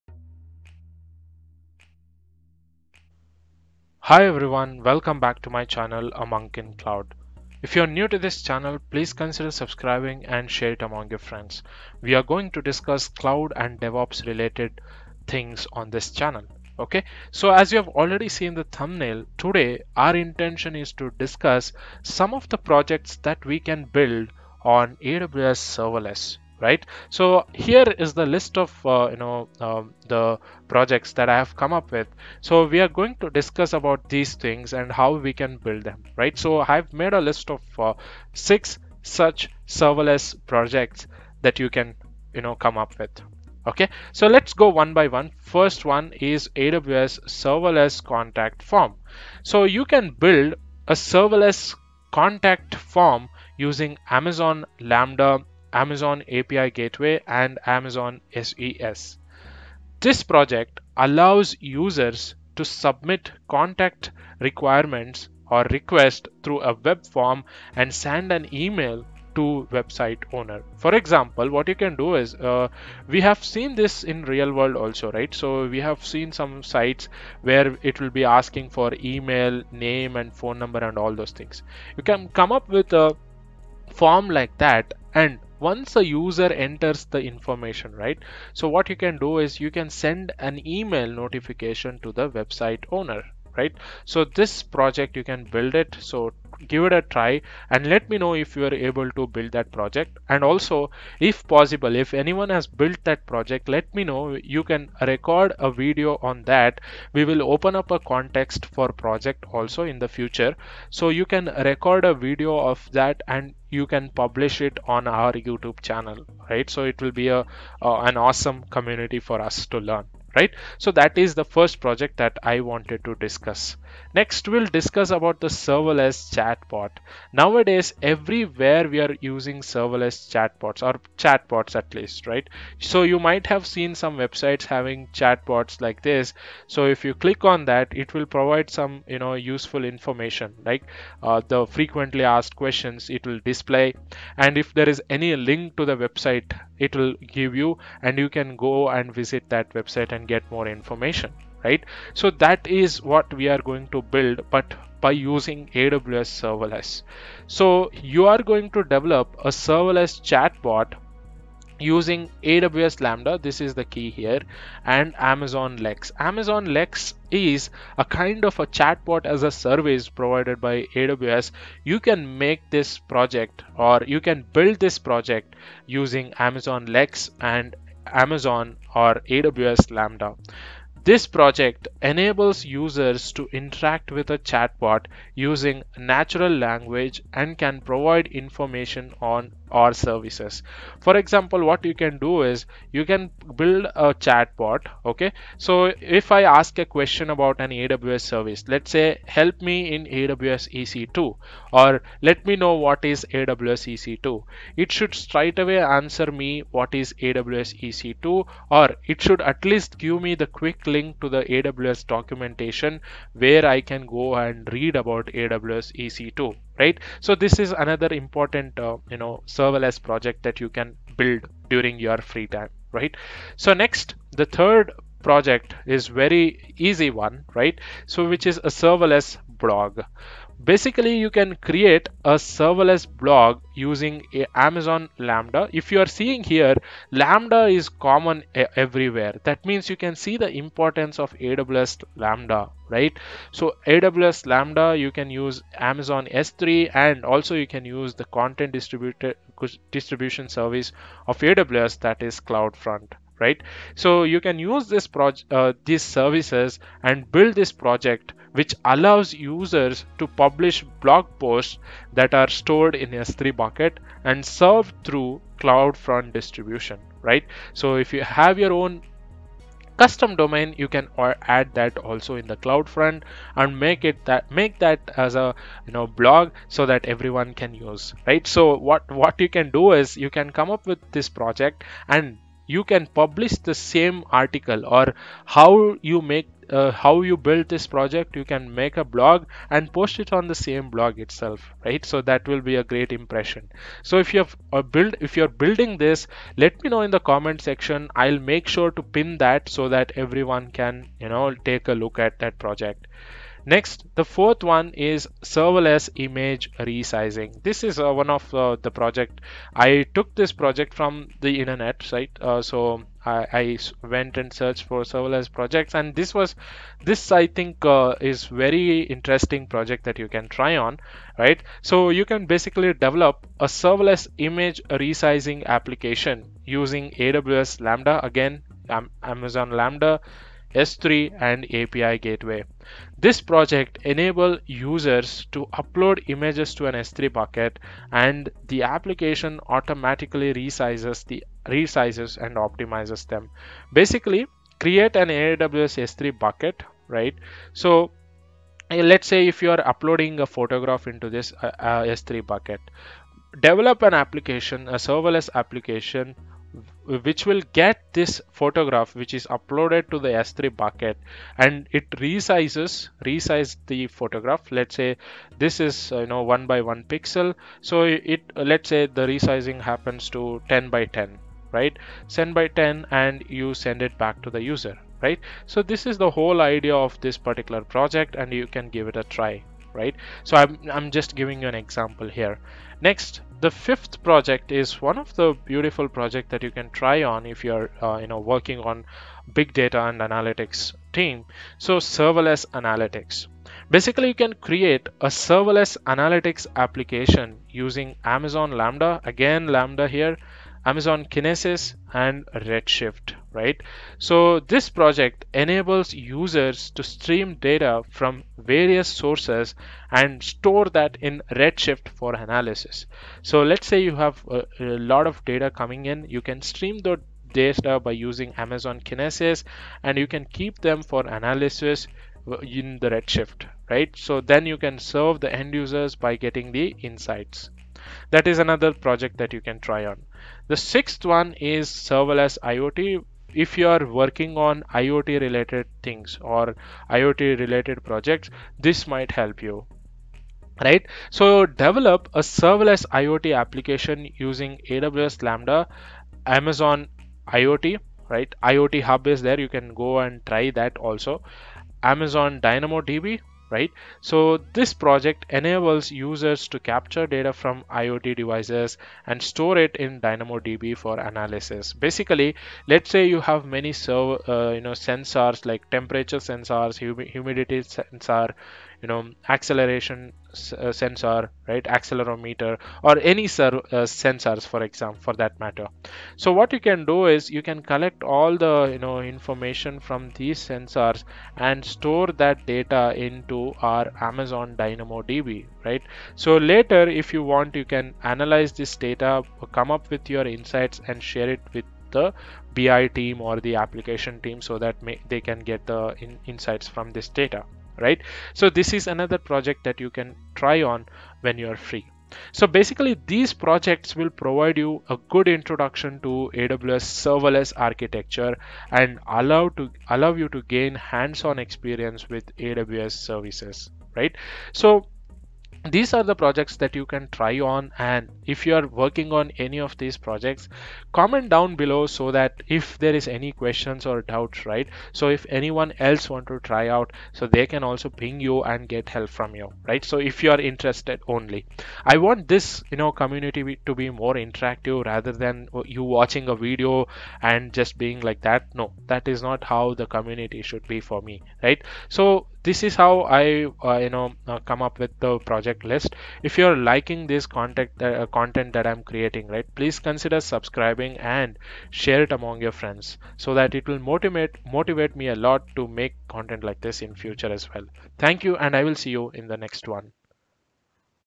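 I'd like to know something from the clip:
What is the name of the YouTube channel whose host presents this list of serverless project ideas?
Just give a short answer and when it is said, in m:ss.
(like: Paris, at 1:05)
A Monk in Cloud, at 0:06.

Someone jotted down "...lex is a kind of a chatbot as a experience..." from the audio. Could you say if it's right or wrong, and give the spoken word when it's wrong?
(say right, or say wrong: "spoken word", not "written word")
wrong: "service", not "experience".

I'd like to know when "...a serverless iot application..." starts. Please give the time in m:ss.
7:22.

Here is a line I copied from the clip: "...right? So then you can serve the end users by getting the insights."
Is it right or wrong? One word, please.
right.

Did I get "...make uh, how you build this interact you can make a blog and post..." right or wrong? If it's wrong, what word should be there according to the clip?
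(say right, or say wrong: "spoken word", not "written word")
wrong: "project", not "interact".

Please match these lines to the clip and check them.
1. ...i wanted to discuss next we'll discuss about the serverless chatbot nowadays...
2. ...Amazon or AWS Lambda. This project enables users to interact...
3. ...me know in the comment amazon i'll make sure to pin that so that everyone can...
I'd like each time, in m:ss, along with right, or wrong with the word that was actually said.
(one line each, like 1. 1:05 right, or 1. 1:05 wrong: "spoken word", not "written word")
1. 2:02 right
2. 2:58 right
3. 4:56 wrong: "section", not "amazon".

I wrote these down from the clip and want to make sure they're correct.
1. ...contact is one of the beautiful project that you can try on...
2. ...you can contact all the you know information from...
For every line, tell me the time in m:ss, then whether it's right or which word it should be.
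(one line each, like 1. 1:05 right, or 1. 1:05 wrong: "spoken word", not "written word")
1. 6:24 wrong: "project", not "contact"
2. 7:57 wrong: "collect", not "contact".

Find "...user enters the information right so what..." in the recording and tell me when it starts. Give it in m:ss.
1:26.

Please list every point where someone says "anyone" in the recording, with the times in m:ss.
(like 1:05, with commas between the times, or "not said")
1:42, 8:45.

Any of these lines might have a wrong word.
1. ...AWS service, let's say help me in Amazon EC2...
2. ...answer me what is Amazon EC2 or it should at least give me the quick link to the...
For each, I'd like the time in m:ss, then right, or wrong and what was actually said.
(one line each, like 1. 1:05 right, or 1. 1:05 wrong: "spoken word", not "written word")
1. 3:17 wrong: "AWS", not "Amazon"
2. 3:25 wrong: "AWS", not "Amazon".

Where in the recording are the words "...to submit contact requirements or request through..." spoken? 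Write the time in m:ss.
1:02.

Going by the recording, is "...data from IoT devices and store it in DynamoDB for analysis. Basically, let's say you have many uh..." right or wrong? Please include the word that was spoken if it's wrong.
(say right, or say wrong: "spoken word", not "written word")
right.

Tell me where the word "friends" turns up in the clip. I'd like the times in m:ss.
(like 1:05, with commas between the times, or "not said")
0:11, 9:12.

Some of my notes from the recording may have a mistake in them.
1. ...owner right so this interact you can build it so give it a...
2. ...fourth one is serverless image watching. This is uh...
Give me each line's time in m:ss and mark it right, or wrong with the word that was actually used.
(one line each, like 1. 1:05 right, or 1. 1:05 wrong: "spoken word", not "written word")
1. 1:32 wrong: "project", not "interact"
2. 5:04 wrong: "resizing", not "watching".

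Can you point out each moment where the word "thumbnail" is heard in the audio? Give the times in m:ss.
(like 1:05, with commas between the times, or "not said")
0:18.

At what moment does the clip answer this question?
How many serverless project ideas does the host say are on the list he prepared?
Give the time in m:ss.
0:38.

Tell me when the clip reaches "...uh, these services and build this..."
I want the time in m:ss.
4:15.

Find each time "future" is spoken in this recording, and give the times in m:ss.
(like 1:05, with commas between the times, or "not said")
1:50, 9:17.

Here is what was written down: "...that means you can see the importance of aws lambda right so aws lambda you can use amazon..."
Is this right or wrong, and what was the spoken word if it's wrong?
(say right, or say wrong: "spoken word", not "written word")
right.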